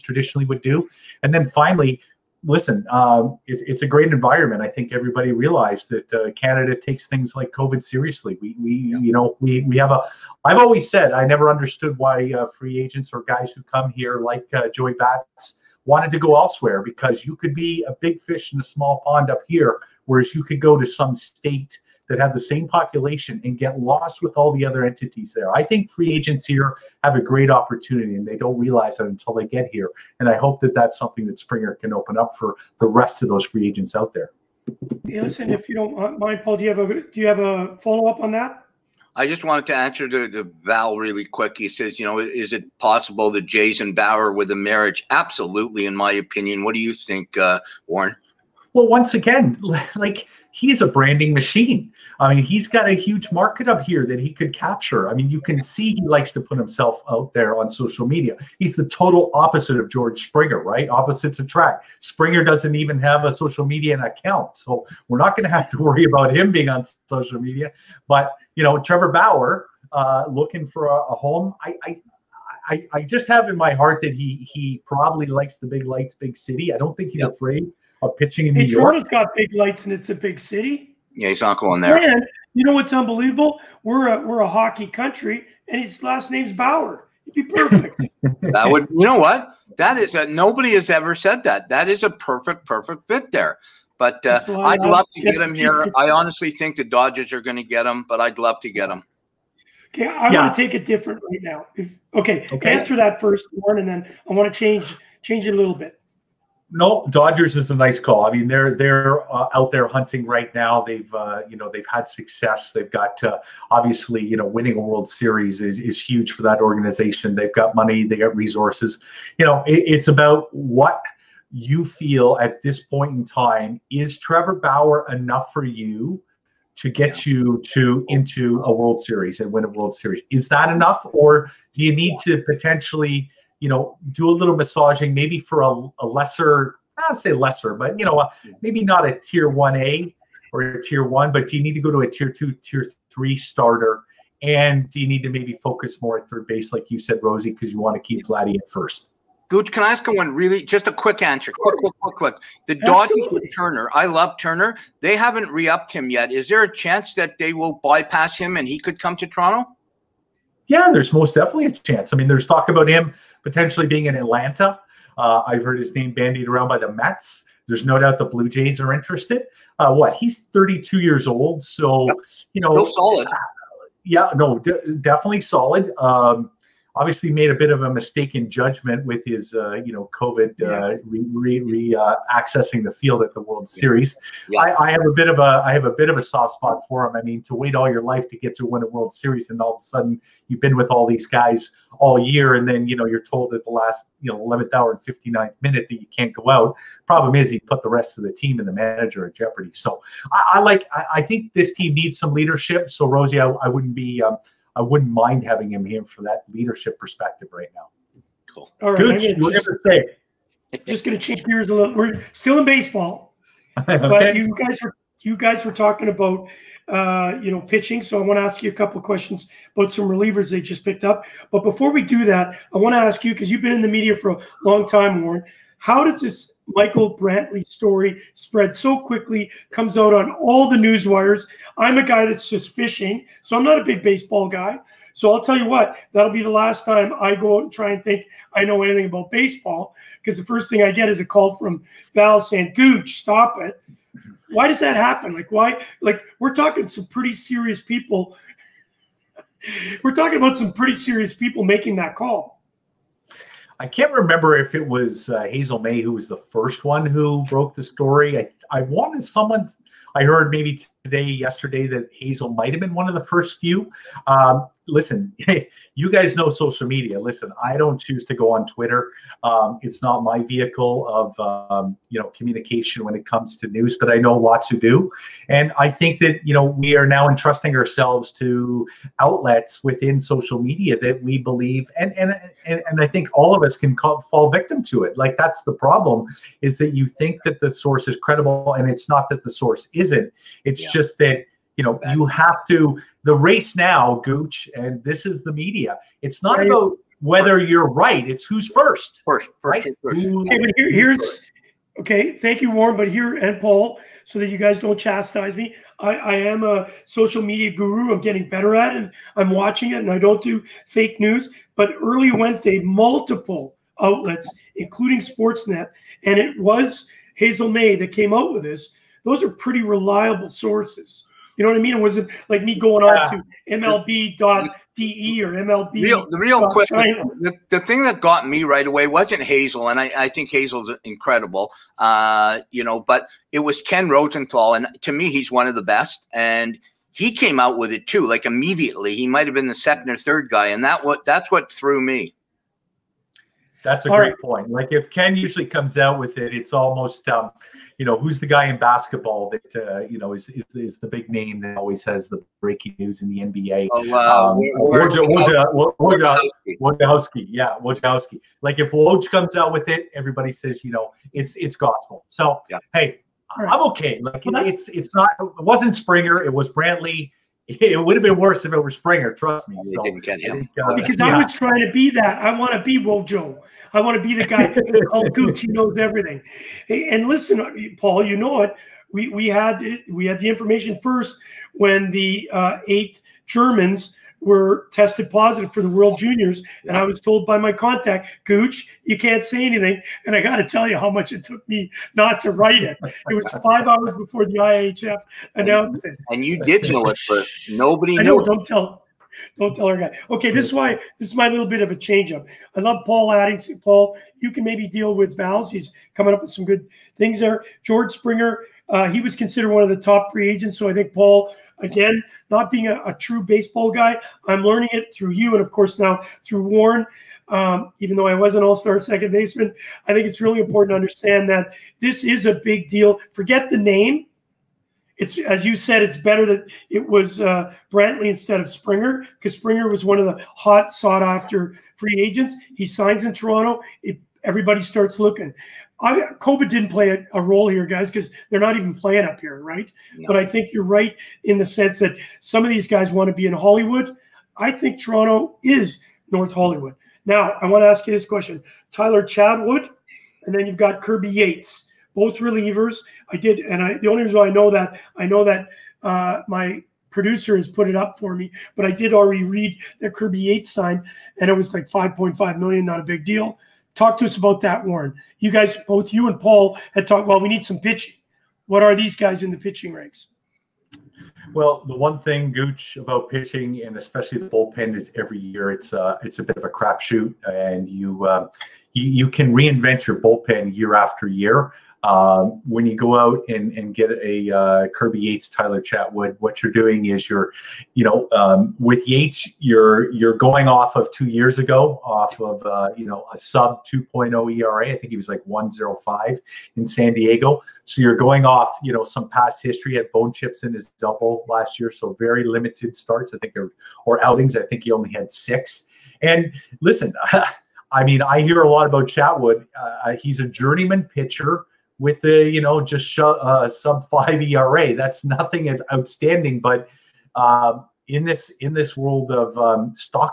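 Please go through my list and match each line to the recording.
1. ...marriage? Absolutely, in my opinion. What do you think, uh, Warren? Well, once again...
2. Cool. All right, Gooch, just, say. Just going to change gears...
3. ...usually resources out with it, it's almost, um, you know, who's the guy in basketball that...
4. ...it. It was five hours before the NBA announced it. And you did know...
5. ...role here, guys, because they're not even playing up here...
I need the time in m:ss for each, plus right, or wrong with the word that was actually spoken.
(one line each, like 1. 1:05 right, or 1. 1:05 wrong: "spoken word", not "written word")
1. 0:44 right
2. 3:28 right
3. 5:45 wrong: "comes", not "resources"
4. 6:32 wrong: "IHF", not "NBA"
5. 7:17 right.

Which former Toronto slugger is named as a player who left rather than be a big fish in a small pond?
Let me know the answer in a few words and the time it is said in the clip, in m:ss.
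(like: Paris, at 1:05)
Joey Bats, at 0:14.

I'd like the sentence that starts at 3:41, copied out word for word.
But before we do that, I want to ask you because you've been in the media for a long time, Warren.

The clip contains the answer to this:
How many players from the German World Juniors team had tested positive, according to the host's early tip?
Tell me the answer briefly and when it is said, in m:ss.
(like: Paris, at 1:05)
8, at 6:22.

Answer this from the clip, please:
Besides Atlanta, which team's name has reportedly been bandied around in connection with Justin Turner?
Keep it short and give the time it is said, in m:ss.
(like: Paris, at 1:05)
Mets, at 2:46.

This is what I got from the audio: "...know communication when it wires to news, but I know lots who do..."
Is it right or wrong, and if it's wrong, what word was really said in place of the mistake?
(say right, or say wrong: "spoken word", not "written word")
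wrong: "comes", not "wires".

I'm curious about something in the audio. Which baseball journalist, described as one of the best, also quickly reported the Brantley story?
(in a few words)
Ken Rosenthal.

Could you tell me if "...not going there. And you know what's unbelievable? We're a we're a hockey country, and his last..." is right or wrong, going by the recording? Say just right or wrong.
right.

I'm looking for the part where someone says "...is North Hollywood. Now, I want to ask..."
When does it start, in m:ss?
7:25.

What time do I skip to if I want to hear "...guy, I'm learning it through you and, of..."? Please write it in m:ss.
6:53.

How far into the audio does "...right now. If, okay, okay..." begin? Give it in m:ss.
1:41.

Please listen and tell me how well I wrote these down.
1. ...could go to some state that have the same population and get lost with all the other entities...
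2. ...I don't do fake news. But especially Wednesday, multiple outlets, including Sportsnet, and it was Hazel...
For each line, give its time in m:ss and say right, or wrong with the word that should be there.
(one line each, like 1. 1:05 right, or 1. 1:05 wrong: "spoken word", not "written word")
1. 0:20 right
2. 5:10 wrong: "early", not "especially".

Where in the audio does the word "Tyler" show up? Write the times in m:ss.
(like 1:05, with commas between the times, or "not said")
7:28, 8:05.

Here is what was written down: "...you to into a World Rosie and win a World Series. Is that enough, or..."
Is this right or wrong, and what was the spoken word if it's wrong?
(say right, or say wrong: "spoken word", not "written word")
wrong: "Series", not "Rosie".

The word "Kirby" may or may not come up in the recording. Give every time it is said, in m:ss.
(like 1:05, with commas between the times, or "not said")
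7:31, 7:40, 8:04.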